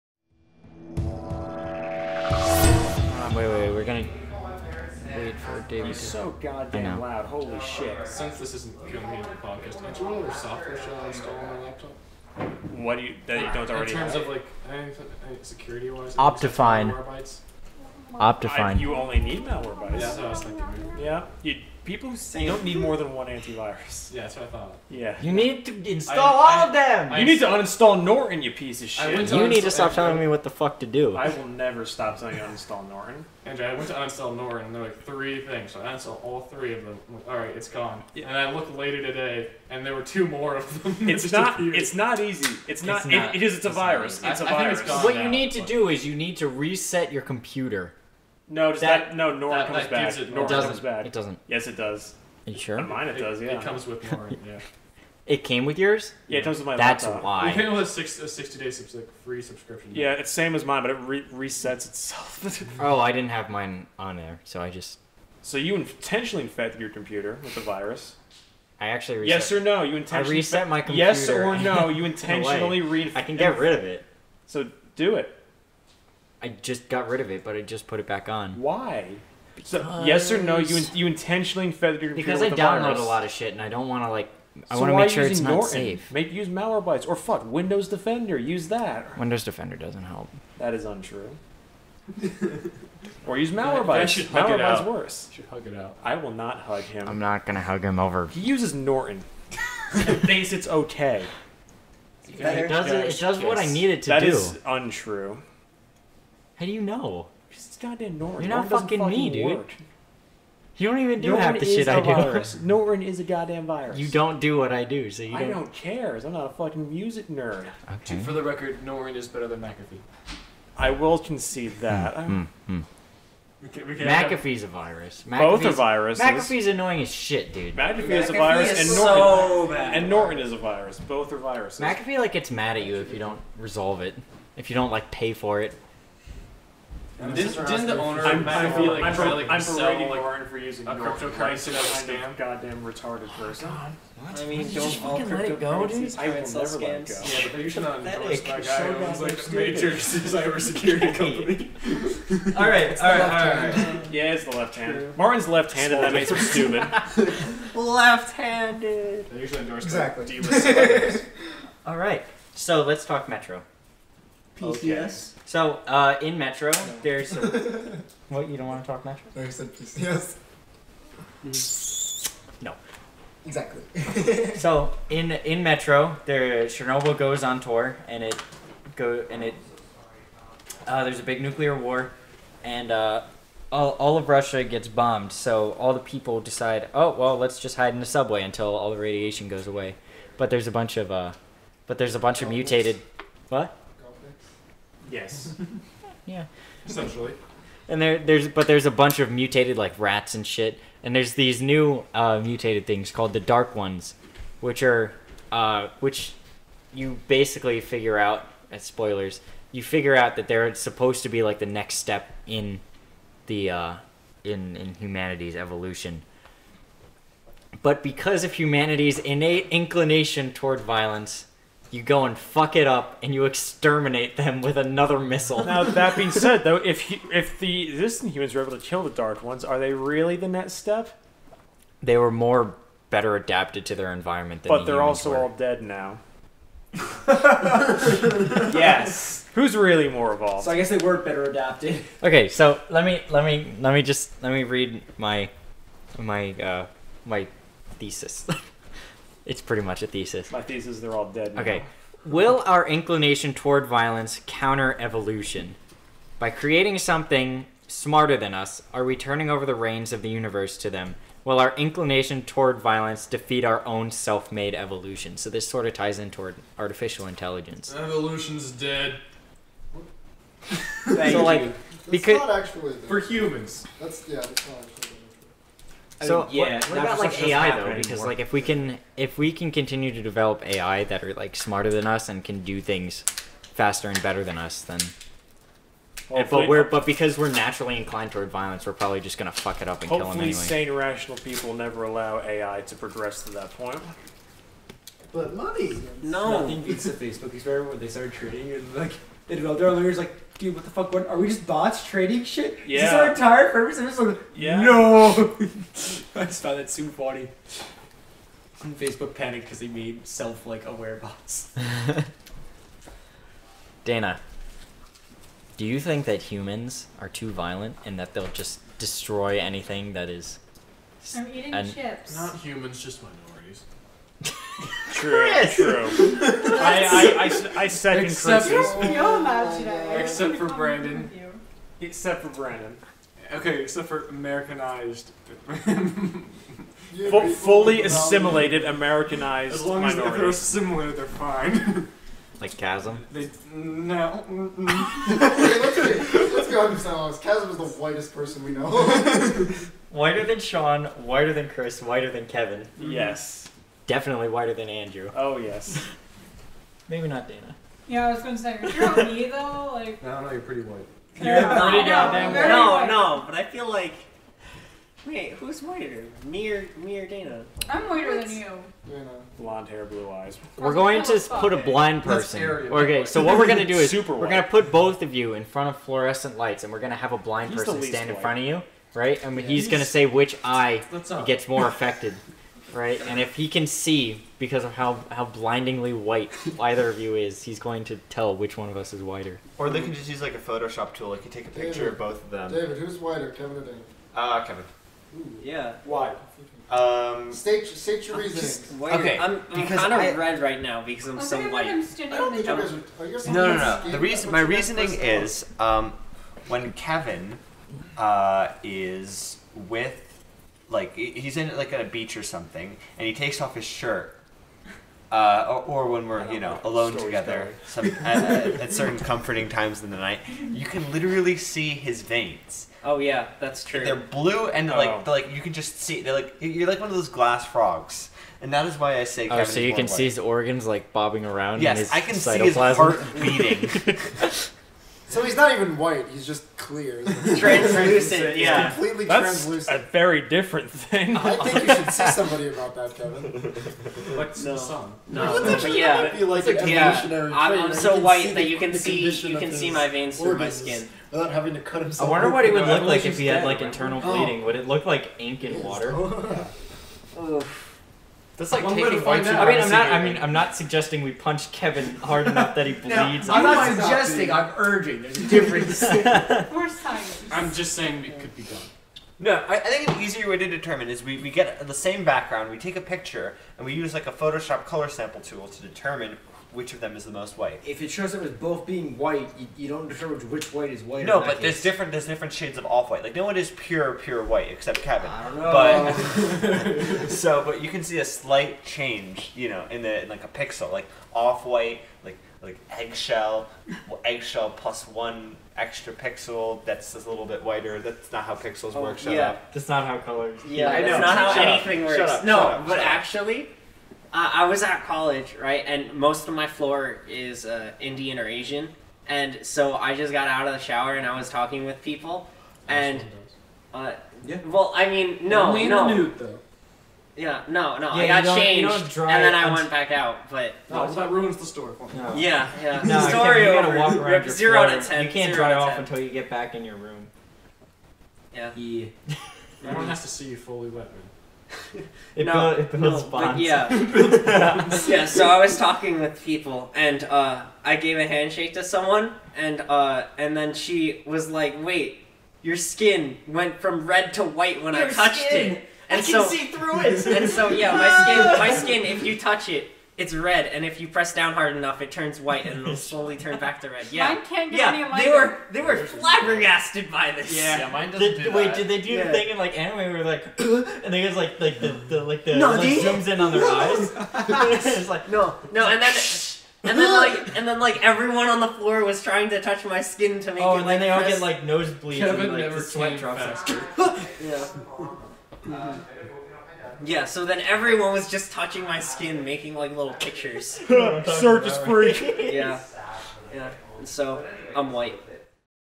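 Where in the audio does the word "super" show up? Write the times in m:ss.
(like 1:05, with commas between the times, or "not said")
5:06, 6:14.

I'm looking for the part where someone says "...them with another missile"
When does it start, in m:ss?
3:44.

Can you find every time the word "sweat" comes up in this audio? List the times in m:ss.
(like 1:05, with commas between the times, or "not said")
9:32.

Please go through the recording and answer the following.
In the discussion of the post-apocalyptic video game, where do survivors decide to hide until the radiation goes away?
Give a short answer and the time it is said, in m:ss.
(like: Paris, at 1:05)
the subway, at 3:08.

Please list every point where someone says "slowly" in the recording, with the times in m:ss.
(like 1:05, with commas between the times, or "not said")
9:12.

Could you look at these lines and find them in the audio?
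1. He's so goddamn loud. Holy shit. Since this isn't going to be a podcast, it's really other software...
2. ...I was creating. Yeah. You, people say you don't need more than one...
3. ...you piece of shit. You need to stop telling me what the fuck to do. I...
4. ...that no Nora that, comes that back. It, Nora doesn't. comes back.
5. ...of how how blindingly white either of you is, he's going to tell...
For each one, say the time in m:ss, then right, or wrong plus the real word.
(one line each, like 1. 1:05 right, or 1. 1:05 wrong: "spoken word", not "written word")
1. 0:05 right
2. 0:20 wrong: "thinking", not "creating"
3. 0:28 right
4. 0:49 right
5. 6:24 right.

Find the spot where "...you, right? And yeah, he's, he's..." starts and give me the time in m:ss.
6:18.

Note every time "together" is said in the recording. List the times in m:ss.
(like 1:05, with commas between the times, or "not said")
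6:57.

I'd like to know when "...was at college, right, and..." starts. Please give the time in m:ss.
8:24.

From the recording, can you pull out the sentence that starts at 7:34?
Would it look like ink and water?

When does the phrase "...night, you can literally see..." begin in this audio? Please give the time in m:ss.
7:00.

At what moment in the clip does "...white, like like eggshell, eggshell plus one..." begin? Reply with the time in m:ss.
8:11.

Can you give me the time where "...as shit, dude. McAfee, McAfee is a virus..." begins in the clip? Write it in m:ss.
2:07.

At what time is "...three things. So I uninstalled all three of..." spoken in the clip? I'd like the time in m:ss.
0:35.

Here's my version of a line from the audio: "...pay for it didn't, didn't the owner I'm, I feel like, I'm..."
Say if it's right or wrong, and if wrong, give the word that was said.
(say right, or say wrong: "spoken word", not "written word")
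right.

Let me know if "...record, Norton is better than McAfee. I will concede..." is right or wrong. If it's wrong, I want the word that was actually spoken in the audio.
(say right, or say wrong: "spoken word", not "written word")
right.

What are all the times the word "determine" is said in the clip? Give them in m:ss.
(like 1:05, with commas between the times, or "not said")
7:50, 7:55, 8:00.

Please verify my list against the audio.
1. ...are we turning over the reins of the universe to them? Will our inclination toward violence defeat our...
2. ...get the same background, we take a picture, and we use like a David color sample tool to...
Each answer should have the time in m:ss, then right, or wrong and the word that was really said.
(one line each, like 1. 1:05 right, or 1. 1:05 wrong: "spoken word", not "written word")
1. 4:18 right
2. 7:51 wrong: "Photoshop", not "David".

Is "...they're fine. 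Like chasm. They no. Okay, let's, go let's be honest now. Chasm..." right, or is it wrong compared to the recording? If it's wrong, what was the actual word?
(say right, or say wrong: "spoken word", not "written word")
right.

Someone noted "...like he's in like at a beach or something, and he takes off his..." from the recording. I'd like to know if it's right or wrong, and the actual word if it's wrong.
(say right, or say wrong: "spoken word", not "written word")
right.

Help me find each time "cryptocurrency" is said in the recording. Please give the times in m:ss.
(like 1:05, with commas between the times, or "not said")
2:20.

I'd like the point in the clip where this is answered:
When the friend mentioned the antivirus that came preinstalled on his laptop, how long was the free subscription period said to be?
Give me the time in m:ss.
0:58.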